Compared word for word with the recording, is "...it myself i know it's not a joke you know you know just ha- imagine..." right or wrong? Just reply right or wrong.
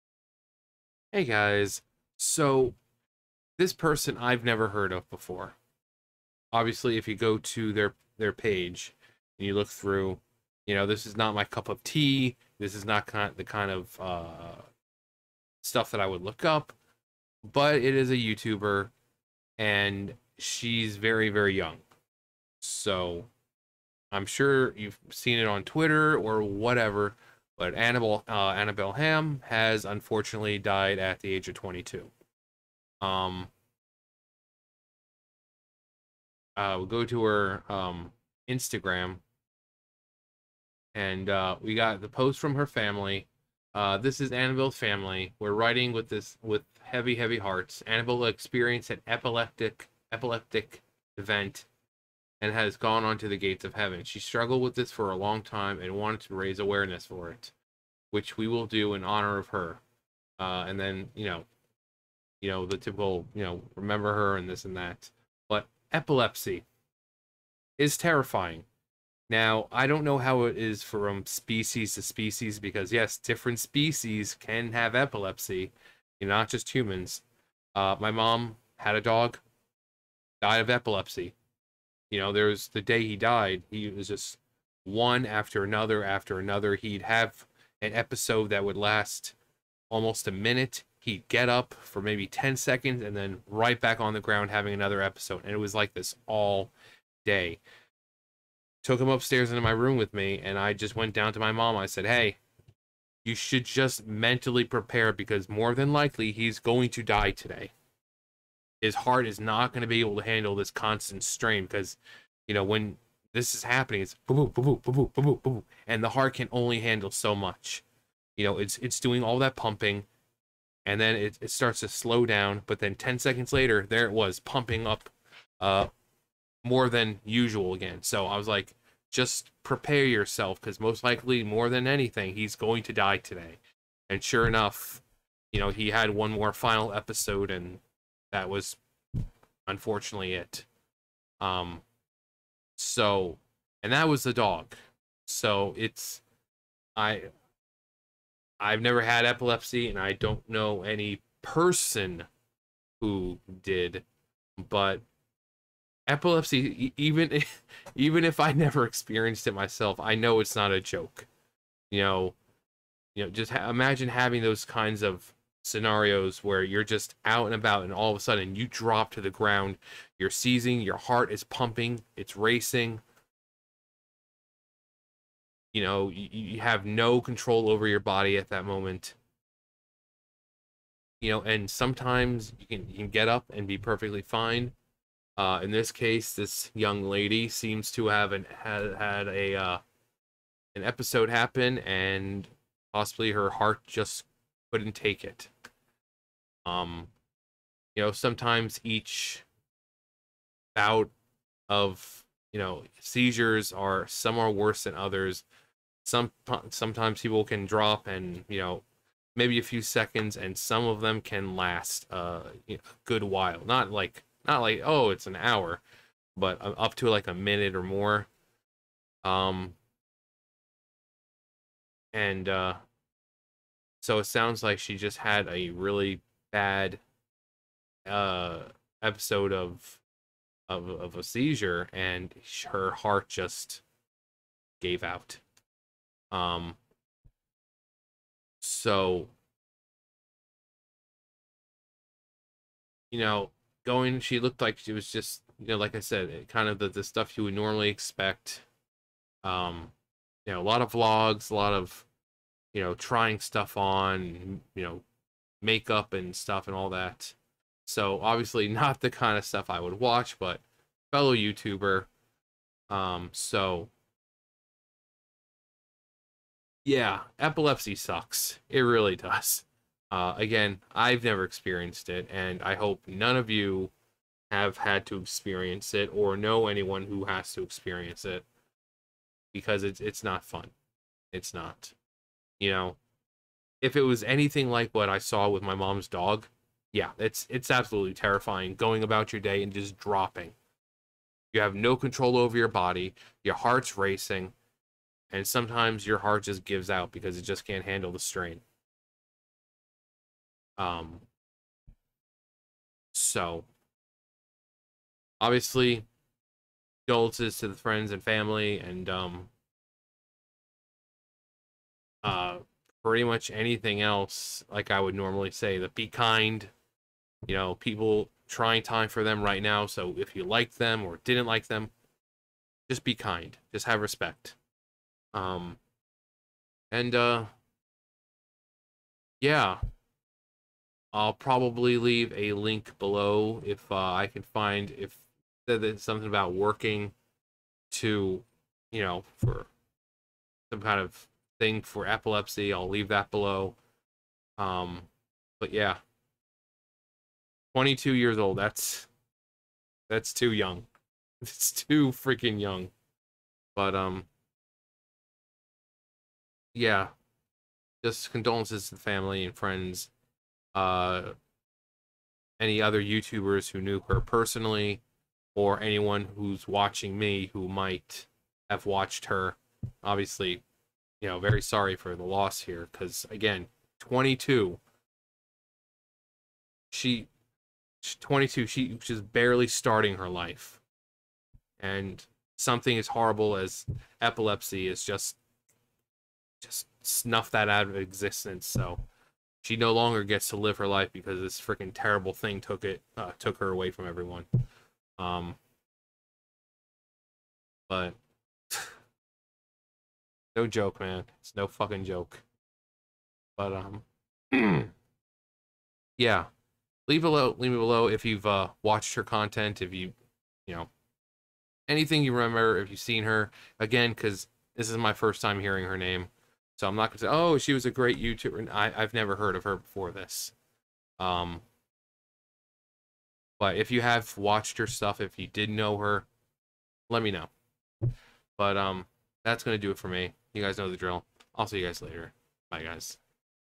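right.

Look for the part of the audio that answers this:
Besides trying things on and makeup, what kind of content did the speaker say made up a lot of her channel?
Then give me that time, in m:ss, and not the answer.
4:10.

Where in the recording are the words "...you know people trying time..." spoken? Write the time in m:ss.
5:17.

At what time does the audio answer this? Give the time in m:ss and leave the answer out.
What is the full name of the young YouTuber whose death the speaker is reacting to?
0:28.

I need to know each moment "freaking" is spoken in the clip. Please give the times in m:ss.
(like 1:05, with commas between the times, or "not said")
5:52, 6:31.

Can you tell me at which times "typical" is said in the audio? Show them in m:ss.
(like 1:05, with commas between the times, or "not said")
1:02.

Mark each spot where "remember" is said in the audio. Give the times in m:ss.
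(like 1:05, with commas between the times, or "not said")
1:03, 6:52.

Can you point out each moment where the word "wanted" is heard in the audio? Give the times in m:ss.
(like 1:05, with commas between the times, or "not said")
0:55.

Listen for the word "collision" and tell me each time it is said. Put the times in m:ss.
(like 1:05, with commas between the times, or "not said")
not said.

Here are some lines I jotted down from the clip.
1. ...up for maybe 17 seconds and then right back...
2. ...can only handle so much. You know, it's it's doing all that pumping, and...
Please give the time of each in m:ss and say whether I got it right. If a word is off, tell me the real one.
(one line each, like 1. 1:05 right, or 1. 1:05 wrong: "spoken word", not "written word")
1. 1:31 wrong: "10", not "17"
2. 1:56 right.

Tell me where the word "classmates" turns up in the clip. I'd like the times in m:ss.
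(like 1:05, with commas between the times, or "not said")
not said.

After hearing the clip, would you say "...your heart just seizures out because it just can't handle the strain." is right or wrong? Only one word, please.
wrong.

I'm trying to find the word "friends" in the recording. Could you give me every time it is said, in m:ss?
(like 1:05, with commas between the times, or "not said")
5:07, 5:59.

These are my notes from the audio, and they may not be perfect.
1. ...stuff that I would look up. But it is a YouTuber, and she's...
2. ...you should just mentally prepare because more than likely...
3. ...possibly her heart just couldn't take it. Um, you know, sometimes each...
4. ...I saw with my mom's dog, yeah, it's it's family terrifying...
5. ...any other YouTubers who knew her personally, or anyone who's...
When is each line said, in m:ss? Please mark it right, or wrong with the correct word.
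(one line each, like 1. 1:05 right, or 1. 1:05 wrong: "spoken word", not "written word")
1. 0:15 right
2. 1:43 right
3. 3:12 right
4. 4:45 wrong: "absolutely", not "family"
5. 6:02 right.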